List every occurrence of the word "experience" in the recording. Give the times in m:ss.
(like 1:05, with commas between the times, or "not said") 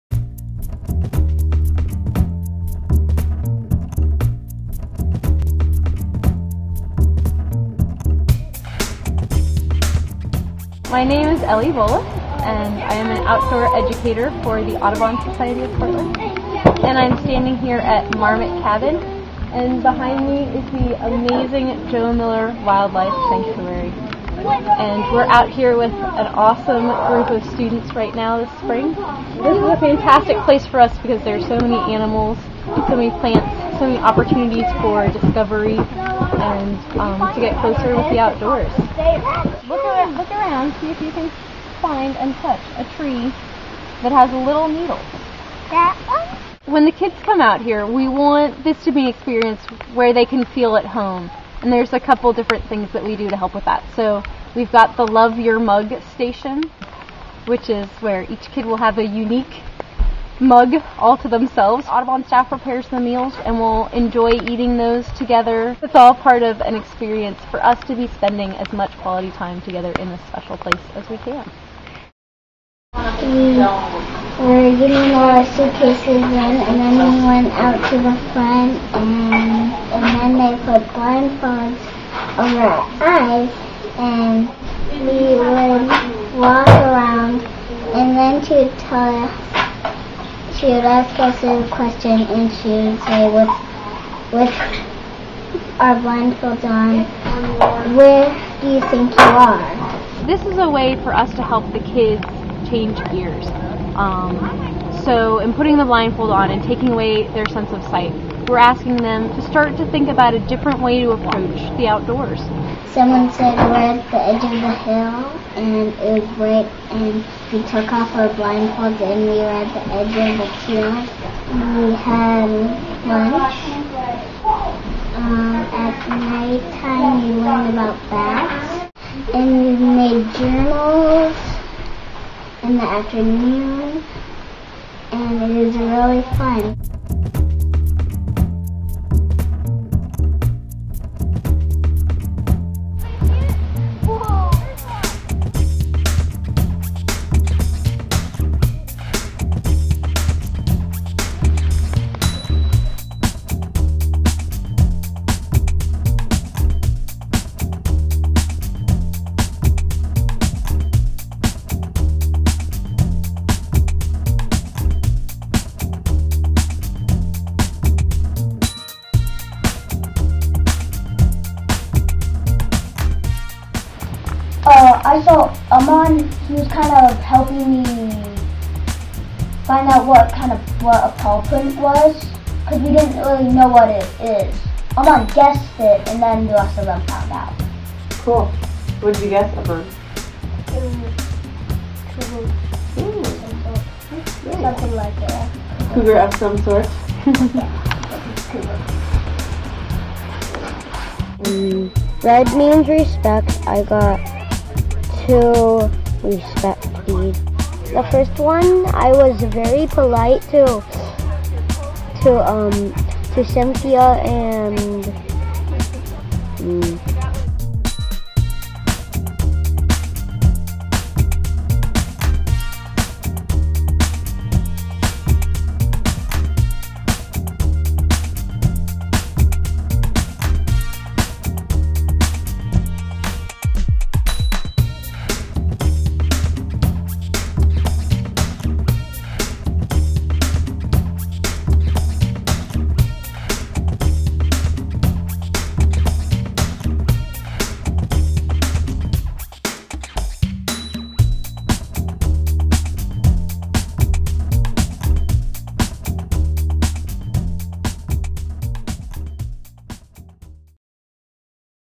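0:49, 1:06.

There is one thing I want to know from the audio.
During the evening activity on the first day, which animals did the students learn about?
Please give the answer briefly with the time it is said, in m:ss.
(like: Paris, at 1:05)
Bats, at 2:08.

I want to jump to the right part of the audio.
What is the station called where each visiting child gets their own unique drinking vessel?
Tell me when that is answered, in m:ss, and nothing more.
0:55.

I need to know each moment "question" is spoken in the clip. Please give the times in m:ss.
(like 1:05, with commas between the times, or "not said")
1:31.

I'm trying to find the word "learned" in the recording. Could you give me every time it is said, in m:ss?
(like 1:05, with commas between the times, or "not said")
2:07.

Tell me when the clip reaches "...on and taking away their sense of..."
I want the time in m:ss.
1:46.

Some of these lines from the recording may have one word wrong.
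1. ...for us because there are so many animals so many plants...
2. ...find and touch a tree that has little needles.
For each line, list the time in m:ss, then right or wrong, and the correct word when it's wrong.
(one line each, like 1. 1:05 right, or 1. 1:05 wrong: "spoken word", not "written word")
1. 0:30 right
2. 0:41 right.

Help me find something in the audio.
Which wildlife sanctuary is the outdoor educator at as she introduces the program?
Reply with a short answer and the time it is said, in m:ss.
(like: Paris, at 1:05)
Joe Miller Wildlife Sanctuary, at 0:21.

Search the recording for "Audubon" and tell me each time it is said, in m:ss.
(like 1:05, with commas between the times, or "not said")
0:14, 1:01.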